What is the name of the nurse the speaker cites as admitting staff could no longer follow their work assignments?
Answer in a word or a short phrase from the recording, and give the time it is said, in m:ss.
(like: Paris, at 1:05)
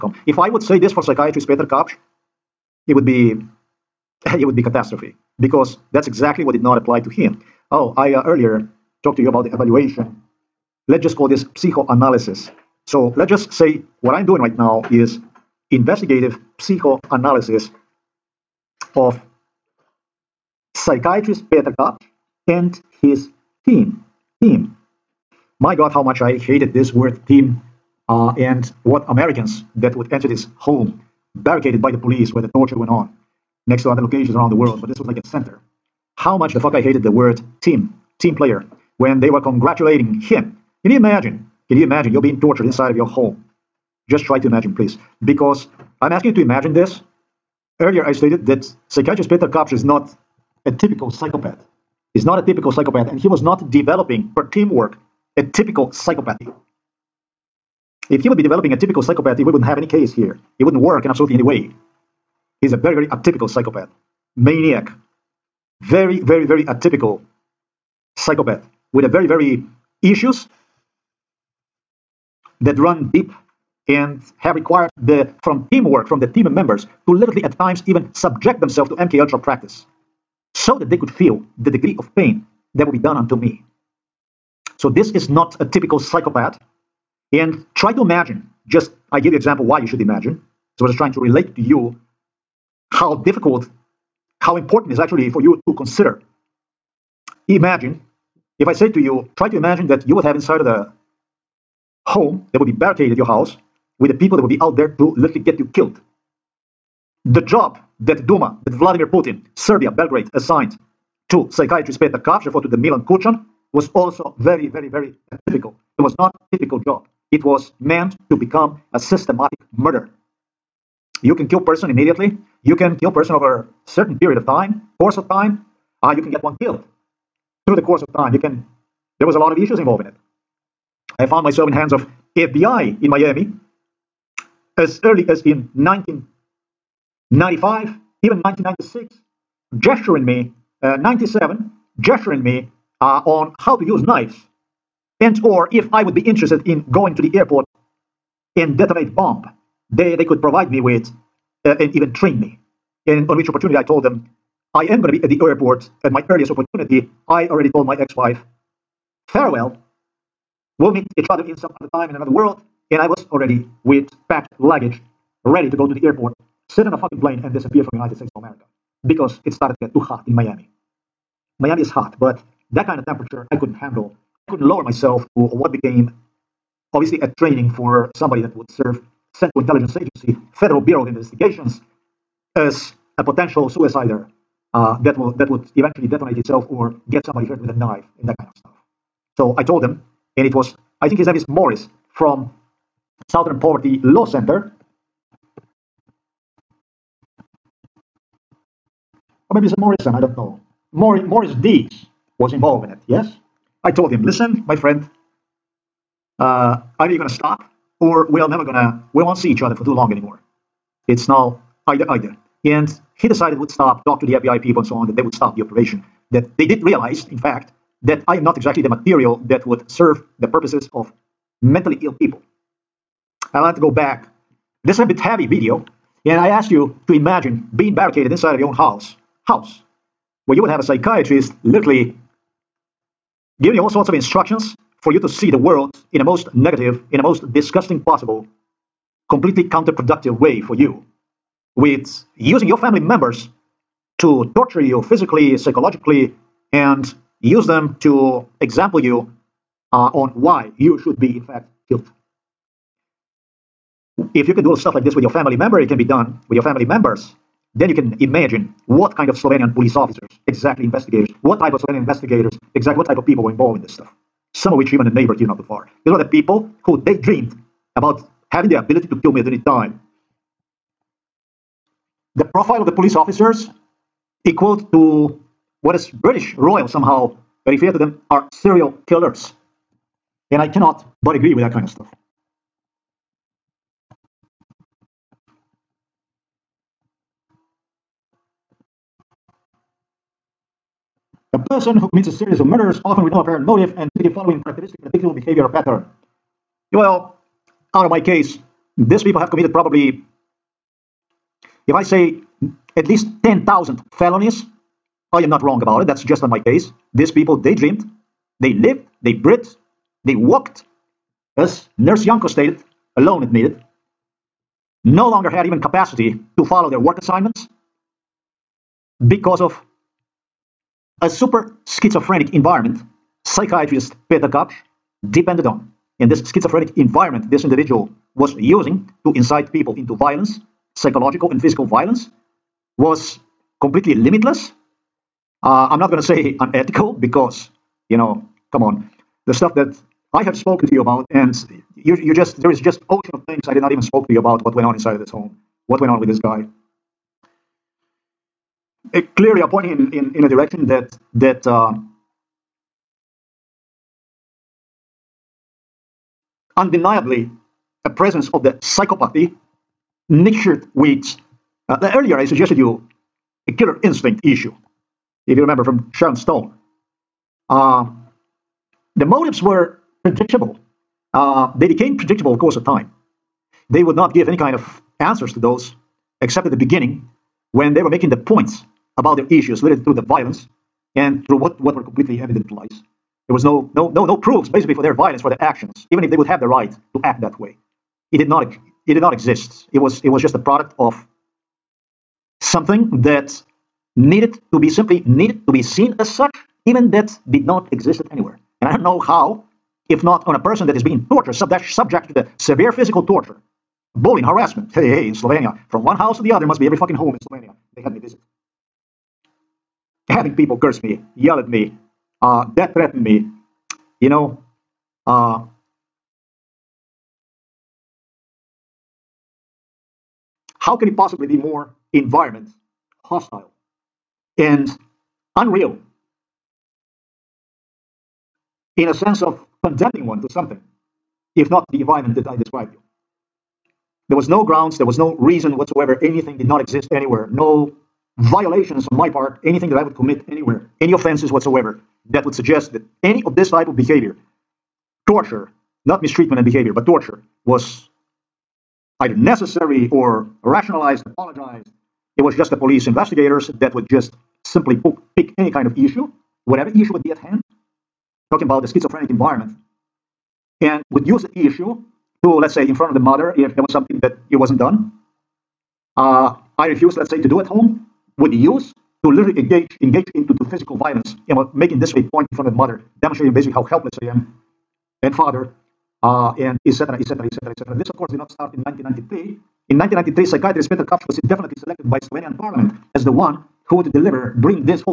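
Yanko, at 5:12.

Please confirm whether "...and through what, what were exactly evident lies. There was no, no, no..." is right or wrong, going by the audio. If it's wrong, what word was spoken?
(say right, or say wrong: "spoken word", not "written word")
wrong: "completely", not "exactly".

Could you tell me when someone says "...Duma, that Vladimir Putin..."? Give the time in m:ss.
1:48.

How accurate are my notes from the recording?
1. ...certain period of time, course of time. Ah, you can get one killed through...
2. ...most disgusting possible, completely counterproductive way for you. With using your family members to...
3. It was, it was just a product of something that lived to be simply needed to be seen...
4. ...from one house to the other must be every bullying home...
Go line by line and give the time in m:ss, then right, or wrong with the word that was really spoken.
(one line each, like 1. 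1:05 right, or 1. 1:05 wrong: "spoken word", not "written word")
1. 2:03 right
2. 3:57 right
3. 6:29 wrong: "needed", not "lived"
4. 6:45 wrong: "fucking", not "bullying".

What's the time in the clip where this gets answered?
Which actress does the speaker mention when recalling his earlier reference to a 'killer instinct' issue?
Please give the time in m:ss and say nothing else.
6:06.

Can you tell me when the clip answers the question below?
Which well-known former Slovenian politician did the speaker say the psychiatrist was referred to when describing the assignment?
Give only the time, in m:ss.
1:52.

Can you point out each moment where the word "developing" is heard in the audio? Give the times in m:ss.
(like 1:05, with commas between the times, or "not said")
0:53, 0:58.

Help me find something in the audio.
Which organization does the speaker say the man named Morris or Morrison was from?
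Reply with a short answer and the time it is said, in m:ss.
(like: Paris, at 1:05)
Southern Poverty Law Center, at 3:13.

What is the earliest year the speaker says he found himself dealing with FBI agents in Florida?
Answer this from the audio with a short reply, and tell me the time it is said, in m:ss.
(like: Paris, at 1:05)
1995, at 2:15.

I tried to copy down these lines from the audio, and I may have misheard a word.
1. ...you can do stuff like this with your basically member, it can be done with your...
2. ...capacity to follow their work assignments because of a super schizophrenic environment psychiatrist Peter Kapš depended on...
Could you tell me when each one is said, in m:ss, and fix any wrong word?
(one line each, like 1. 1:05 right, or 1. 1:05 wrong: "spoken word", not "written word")
1. 4:14 wrong: "family", not "basically"
2. 5:15 right.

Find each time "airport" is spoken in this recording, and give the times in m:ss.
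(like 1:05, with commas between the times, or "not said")
2:27, 2:35, 2:46.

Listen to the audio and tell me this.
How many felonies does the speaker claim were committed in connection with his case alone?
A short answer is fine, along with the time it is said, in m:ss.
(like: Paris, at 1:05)
10,000, at 5:03.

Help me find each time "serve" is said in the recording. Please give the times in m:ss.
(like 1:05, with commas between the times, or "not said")
2:58, 3:39.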